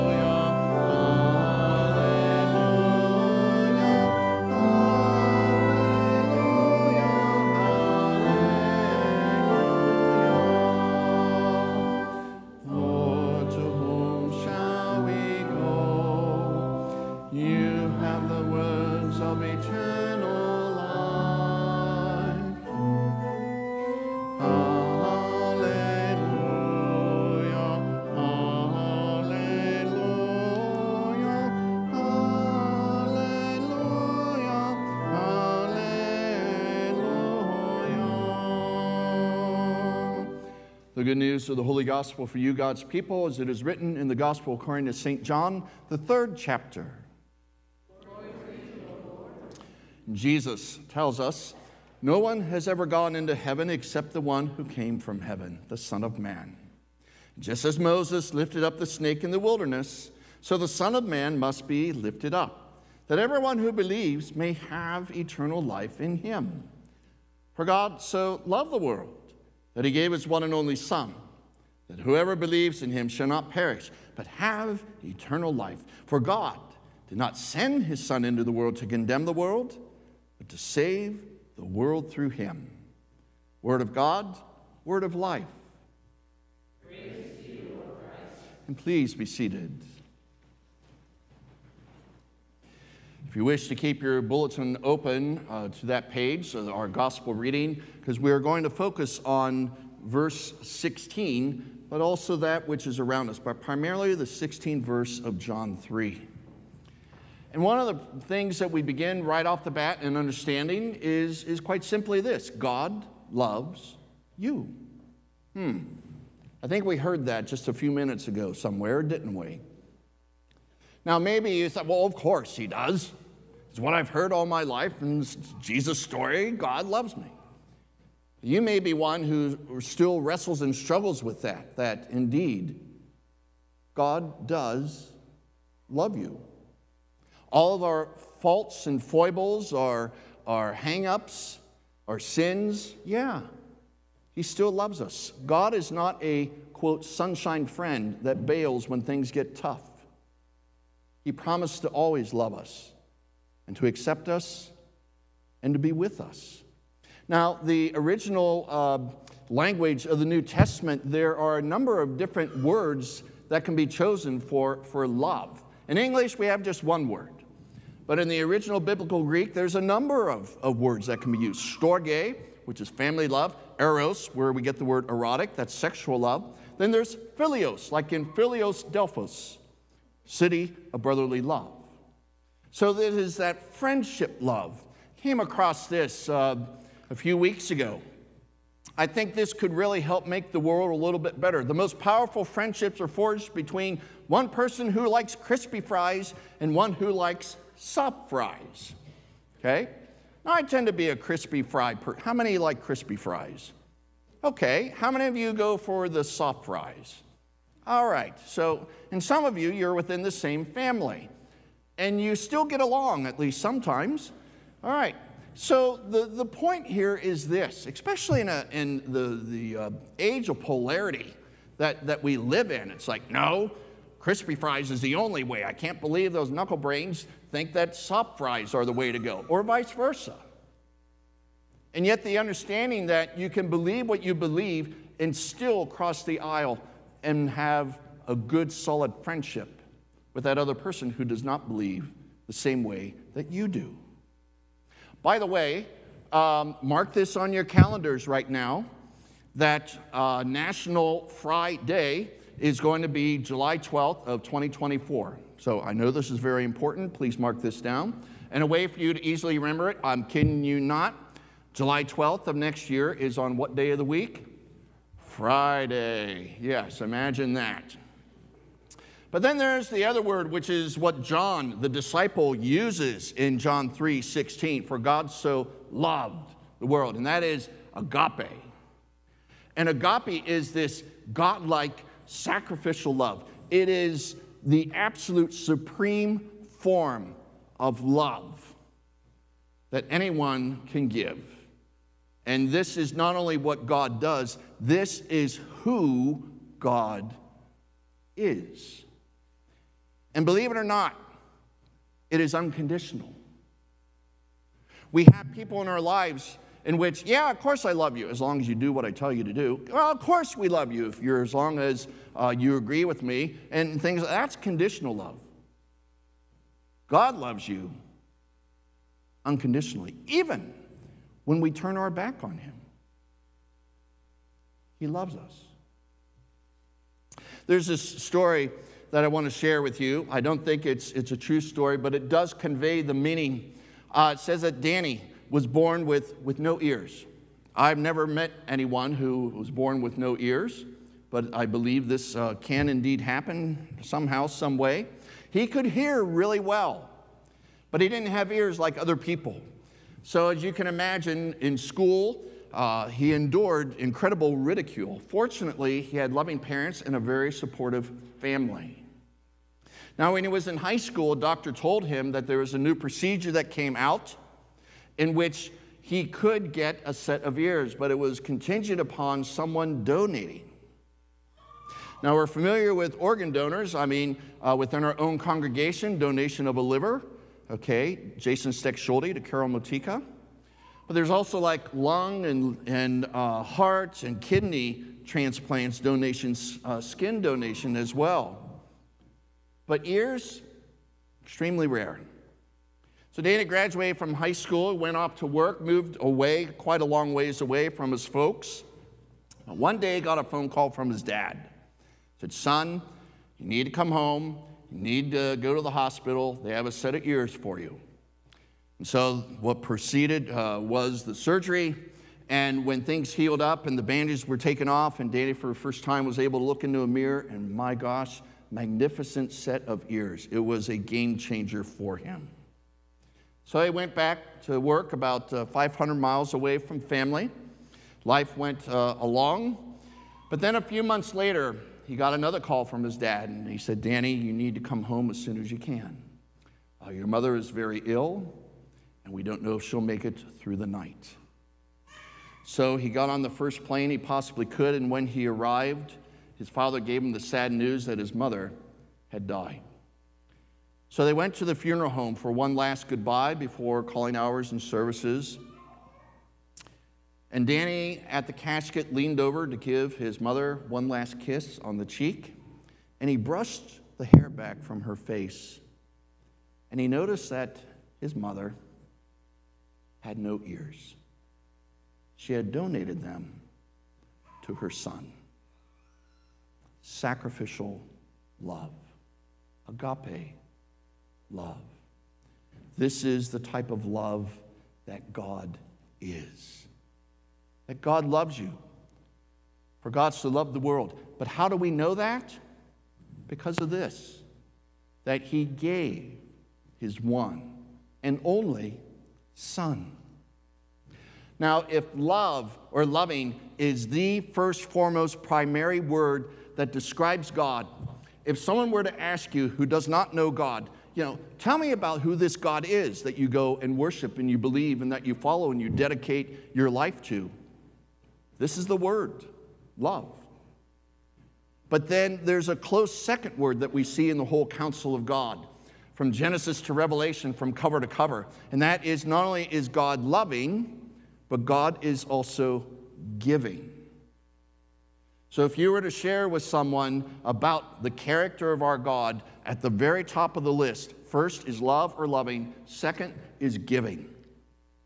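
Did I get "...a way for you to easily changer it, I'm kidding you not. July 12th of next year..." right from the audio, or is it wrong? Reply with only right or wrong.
wrong.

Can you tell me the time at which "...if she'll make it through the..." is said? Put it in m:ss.
7:19.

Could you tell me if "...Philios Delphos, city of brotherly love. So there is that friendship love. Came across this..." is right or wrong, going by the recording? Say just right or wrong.
right.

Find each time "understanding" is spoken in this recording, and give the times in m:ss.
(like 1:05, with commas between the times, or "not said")
1:50, 3:52.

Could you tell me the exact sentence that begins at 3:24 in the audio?
Okay, how many of you go for the soft fries?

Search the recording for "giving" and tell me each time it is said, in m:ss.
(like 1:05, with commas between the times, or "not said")
8:53, 9:03.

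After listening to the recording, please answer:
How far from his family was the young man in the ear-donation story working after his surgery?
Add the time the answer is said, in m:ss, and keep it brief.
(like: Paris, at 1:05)
500 miles, at 7:05.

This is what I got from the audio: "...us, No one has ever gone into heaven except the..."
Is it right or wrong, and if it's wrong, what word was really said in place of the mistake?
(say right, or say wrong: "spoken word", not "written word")
right.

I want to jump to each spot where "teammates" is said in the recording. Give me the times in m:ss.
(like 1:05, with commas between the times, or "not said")
not said.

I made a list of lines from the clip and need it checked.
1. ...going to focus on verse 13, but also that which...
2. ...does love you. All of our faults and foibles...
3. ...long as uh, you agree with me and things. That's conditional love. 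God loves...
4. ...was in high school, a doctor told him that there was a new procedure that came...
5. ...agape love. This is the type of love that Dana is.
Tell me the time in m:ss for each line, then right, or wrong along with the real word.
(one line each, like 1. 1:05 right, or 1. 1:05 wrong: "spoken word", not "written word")
1. 1:38 wrong: "16", not "13"
2. 2:14 right
3. 5:11 right
4. 6:00 right
5. 7:59 wrong: "God", not "Dana".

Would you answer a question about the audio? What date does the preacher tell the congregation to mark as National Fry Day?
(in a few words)
July 12, 2024.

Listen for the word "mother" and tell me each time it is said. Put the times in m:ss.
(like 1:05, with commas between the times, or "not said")
7:17, 7:28, 7:40, 7:48.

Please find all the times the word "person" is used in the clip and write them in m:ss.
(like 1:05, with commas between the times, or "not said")
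3:14, 3:21, 4:00.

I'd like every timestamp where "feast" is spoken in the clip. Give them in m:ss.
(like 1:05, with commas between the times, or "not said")
not said.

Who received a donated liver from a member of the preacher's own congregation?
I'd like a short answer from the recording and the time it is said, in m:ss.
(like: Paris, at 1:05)
Carol Motika, at 6:19.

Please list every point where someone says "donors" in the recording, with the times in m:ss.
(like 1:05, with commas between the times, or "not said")
6:13.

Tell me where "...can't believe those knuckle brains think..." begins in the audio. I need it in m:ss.
3:45.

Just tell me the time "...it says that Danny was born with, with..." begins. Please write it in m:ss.
5:34.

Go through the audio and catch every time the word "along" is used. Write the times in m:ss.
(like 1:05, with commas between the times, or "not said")
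3:32, 7:09.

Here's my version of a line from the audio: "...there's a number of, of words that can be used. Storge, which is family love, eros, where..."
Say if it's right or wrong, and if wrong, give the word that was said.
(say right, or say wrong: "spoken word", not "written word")
right.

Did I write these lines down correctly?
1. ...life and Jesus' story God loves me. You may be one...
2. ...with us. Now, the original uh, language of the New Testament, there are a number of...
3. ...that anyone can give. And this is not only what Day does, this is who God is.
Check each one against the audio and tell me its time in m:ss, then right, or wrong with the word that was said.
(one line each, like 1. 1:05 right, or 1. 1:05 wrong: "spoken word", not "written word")
1. 2:04 right
2. 2:35 right
3. 4:49 wrong: "God", not "Day".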